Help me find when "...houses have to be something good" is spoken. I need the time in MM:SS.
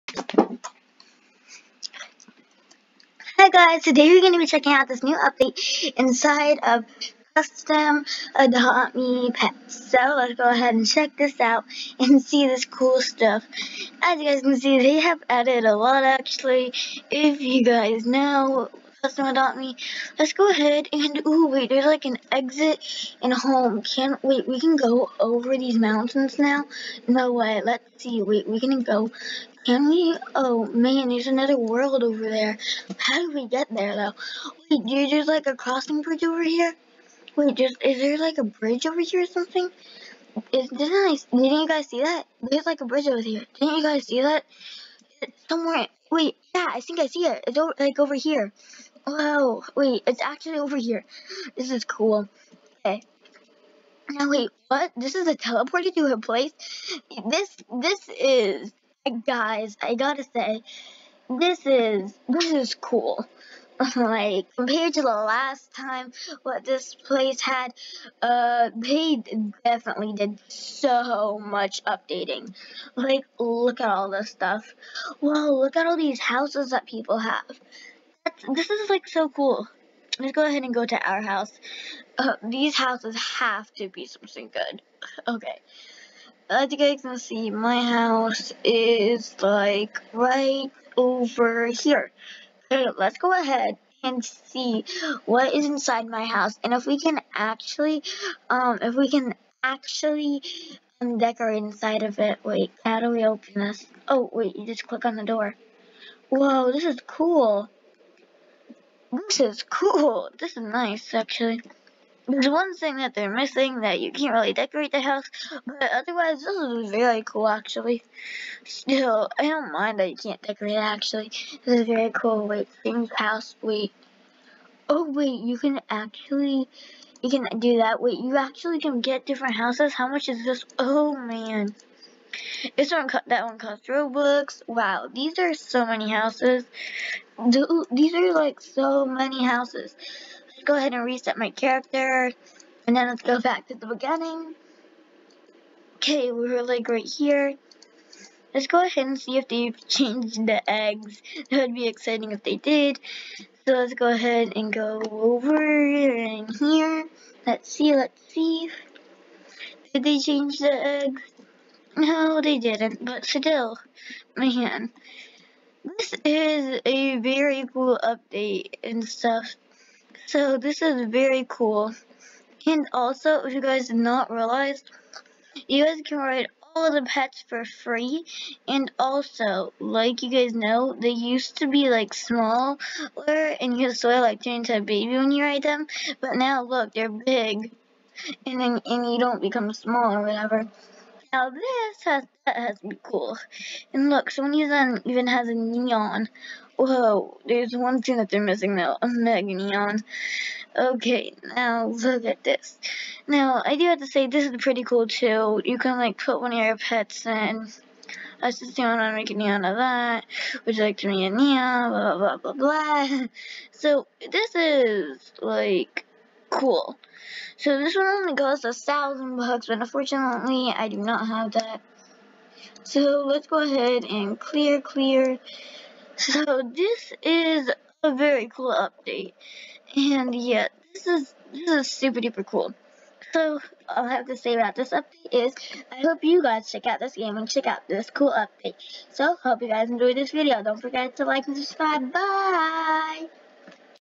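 01:22.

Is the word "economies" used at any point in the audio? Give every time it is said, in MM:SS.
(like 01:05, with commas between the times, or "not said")
not said.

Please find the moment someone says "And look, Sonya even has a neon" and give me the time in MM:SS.
03:13.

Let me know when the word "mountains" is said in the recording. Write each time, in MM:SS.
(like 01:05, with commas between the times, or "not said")
00:25.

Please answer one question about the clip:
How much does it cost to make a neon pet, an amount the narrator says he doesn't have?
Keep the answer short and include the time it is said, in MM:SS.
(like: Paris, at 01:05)
1000 bucks, at 03:38.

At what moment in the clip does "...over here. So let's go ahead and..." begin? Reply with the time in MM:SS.
01:30.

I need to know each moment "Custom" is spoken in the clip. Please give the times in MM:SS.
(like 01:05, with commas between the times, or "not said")
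00:07, 00:19.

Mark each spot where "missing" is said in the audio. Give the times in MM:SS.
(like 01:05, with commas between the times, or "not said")
01:53, 03:18.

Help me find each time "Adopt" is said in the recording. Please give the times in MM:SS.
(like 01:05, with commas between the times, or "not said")
00:08, 00:19.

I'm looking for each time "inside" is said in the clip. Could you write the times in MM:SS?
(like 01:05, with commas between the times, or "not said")
00:05, 01:35, 01:41.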